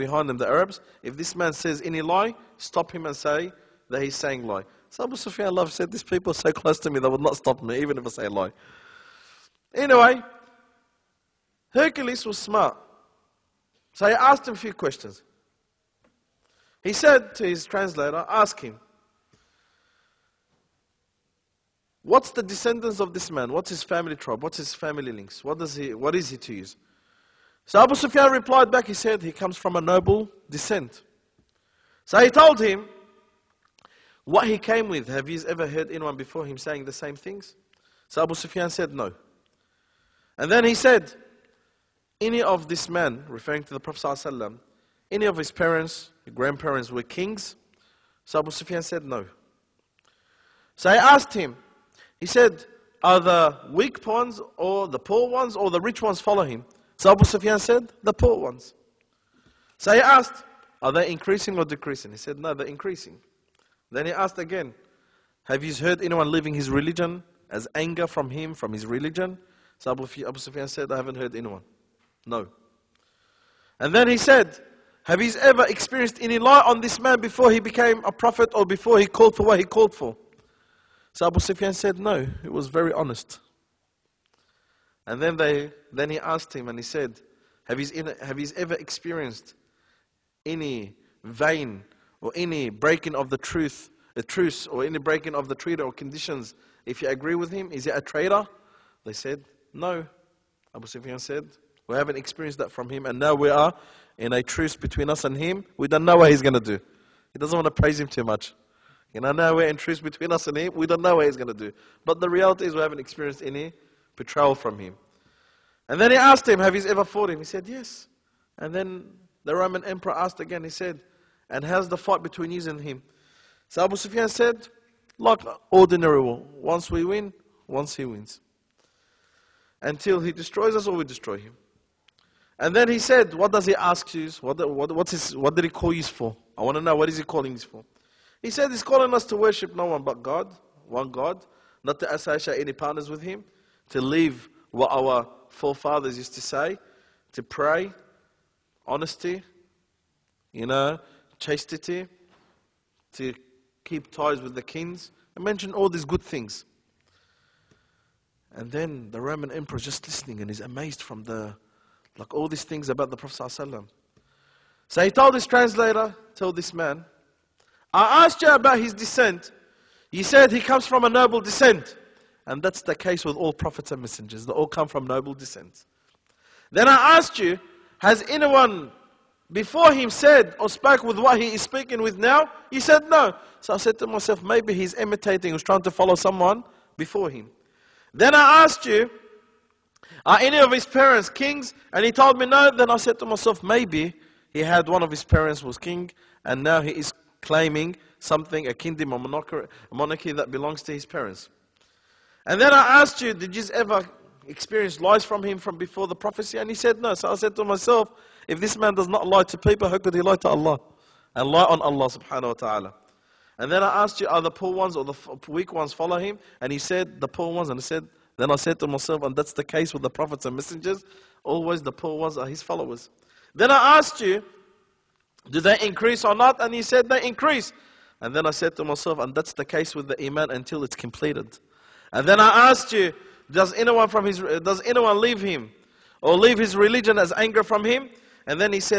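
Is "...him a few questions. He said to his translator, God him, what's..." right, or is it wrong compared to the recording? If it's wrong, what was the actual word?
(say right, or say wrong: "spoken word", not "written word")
wrong: "Ask", not "God".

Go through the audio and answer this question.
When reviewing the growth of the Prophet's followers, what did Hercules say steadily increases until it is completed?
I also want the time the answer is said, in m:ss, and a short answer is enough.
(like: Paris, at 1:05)
Iman, at 3:50.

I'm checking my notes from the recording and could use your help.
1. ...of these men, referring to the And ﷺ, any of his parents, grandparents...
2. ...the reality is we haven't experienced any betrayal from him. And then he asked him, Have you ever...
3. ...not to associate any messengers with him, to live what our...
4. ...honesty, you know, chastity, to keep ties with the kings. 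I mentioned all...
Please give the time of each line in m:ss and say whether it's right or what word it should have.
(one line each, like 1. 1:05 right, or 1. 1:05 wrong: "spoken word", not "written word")
1. 0:42 wrong: "Prophet", not "And"
2. 1:52 right
3. 2:21 wrong: "partners", not "messengers"
4. 2:28 right.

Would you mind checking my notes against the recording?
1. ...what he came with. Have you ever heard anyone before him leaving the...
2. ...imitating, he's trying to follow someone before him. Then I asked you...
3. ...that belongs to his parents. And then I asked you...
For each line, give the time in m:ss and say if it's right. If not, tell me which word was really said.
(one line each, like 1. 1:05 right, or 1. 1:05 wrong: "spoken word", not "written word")
1. 0:34 wrong: "saying", not "leaving"
2. 3:04 right
3. 3:20 right.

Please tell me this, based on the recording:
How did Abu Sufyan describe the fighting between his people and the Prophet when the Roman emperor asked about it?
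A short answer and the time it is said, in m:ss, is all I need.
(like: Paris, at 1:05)
Like ordinary war, at 2:05.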